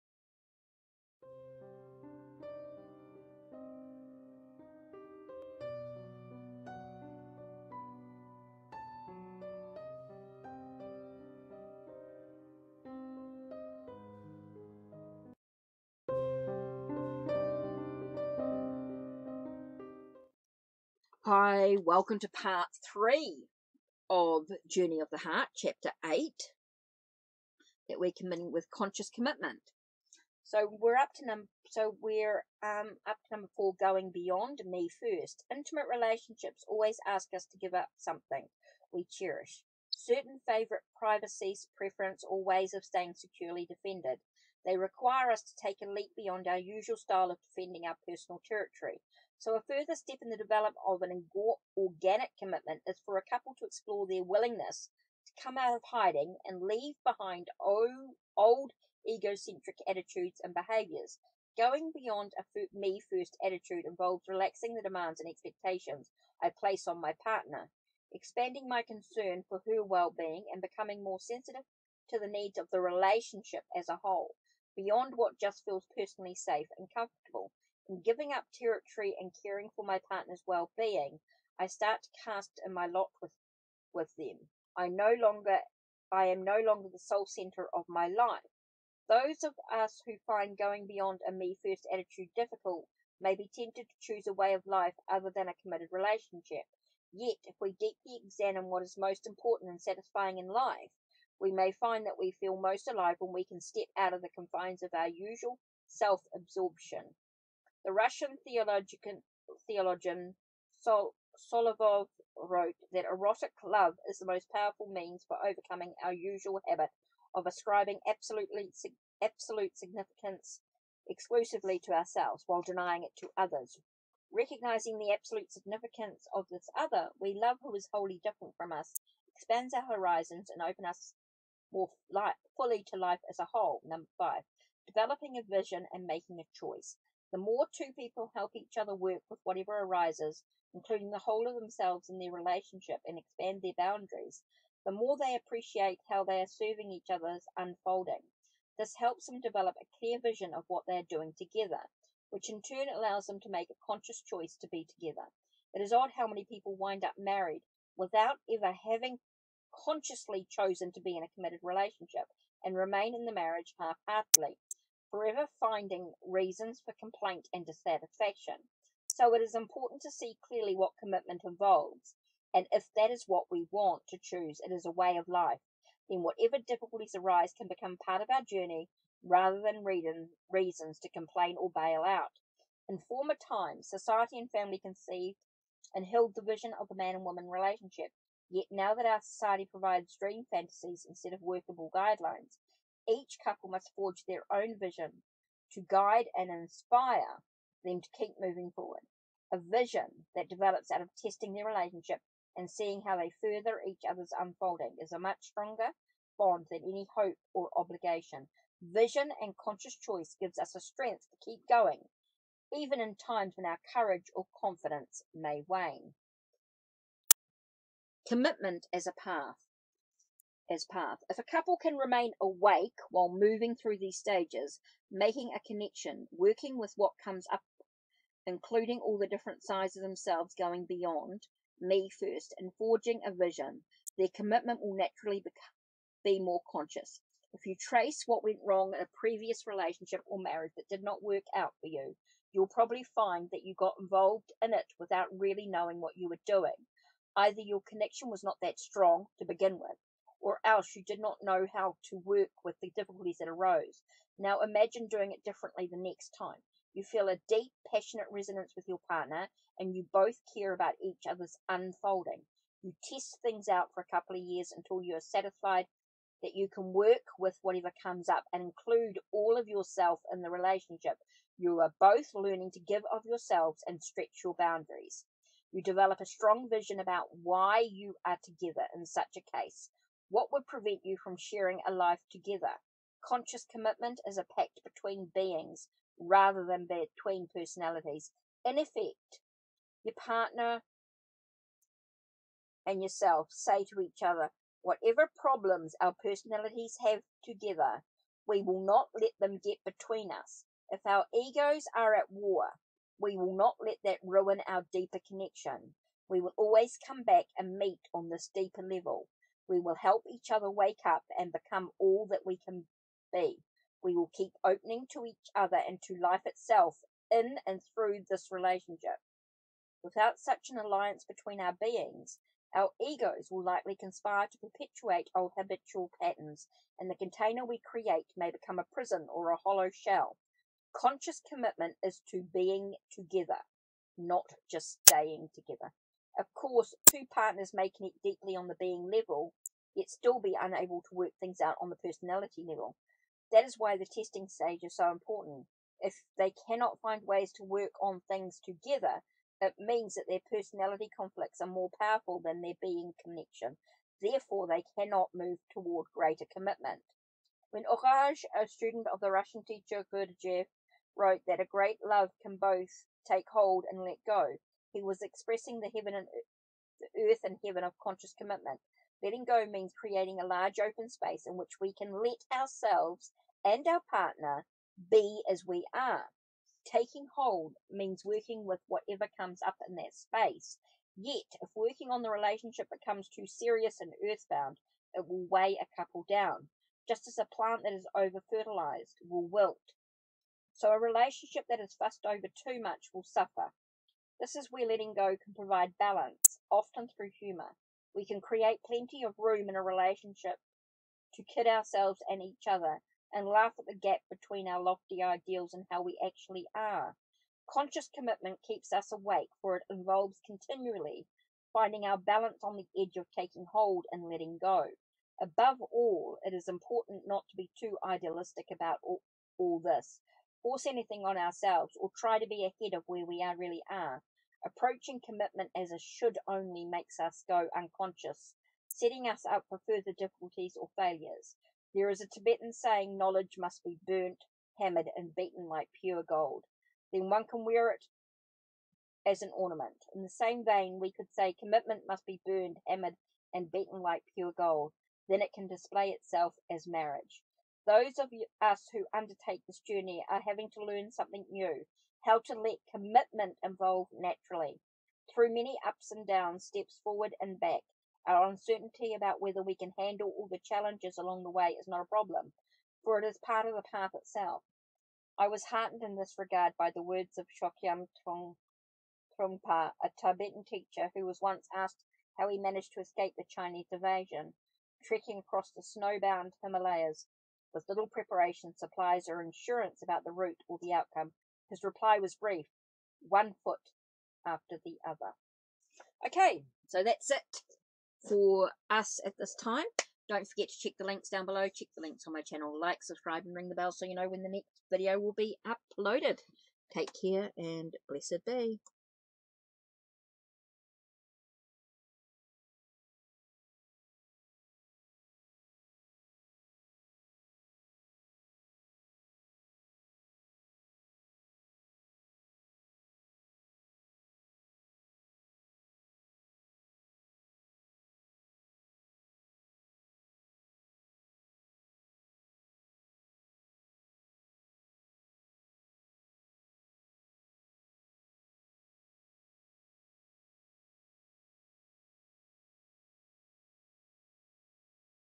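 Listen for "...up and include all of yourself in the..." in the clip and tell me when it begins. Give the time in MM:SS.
04:28.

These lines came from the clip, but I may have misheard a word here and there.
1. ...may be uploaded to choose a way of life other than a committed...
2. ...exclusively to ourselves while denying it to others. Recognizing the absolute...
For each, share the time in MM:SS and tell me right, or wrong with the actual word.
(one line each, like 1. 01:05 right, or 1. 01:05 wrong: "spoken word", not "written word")
1. 01:33 wrong: "tempted", not "uploaded"
2. 02:01 right.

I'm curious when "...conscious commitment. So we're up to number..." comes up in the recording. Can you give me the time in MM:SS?
00:28.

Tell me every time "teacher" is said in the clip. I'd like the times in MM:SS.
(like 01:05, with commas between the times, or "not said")
05:59, 07:50.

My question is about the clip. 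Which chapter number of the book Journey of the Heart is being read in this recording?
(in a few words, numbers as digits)
8.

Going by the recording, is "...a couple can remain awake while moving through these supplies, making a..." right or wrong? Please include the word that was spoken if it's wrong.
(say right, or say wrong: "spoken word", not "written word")
wrong: "stages", not "supplies".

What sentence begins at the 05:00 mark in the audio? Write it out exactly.
If our egos are at war, we will not let that ruin our deeper connection.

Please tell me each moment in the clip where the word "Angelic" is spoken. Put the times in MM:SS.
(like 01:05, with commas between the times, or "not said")
not said.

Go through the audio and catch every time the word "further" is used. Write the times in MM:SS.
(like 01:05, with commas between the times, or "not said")
00:49, 03:23, 07:09.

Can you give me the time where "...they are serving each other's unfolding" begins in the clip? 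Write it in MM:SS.
02:26.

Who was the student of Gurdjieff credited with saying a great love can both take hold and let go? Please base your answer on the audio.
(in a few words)
Orage.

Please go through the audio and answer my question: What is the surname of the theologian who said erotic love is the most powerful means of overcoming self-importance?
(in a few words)
Solovyov.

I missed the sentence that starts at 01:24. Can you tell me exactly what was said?
I no longer I am no longer the sole center of my life.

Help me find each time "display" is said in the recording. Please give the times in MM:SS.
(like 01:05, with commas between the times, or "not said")
07:25.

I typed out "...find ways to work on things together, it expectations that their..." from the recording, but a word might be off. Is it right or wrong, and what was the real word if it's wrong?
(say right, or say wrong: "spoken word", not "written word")
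wrong: "means", not "expectations".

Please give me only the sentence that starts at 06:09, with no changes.
Letting go means creating a large open space in which we can let ourselves and our partner be as we are.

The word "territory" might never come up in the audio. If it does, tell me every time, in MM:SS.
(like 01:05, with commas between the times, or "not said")
00:48, 01:18.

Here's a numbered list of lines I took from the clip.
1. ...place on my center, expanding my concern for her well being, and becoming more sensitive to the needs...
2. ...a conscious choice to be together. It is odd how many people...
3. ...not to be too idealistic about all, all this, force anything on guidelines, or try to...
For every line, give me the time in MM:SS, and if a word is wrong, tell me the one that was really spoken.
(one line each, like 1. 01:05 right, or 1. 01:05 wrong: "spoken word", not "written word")
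1. 01:06 wrong: "partner", not "center"
2. 02:33 right
3. 06:57 wrong: "ourselves", not "guidelines".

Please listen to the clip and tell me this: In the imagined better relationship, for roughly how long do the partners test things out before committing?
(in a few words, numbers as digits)
a couple of years.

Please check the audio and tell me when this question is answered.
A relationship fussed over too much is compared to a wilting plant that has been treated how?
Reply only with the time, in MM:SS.
06:28.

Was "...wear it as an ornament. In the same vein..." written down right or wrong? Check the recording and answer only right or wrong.
right.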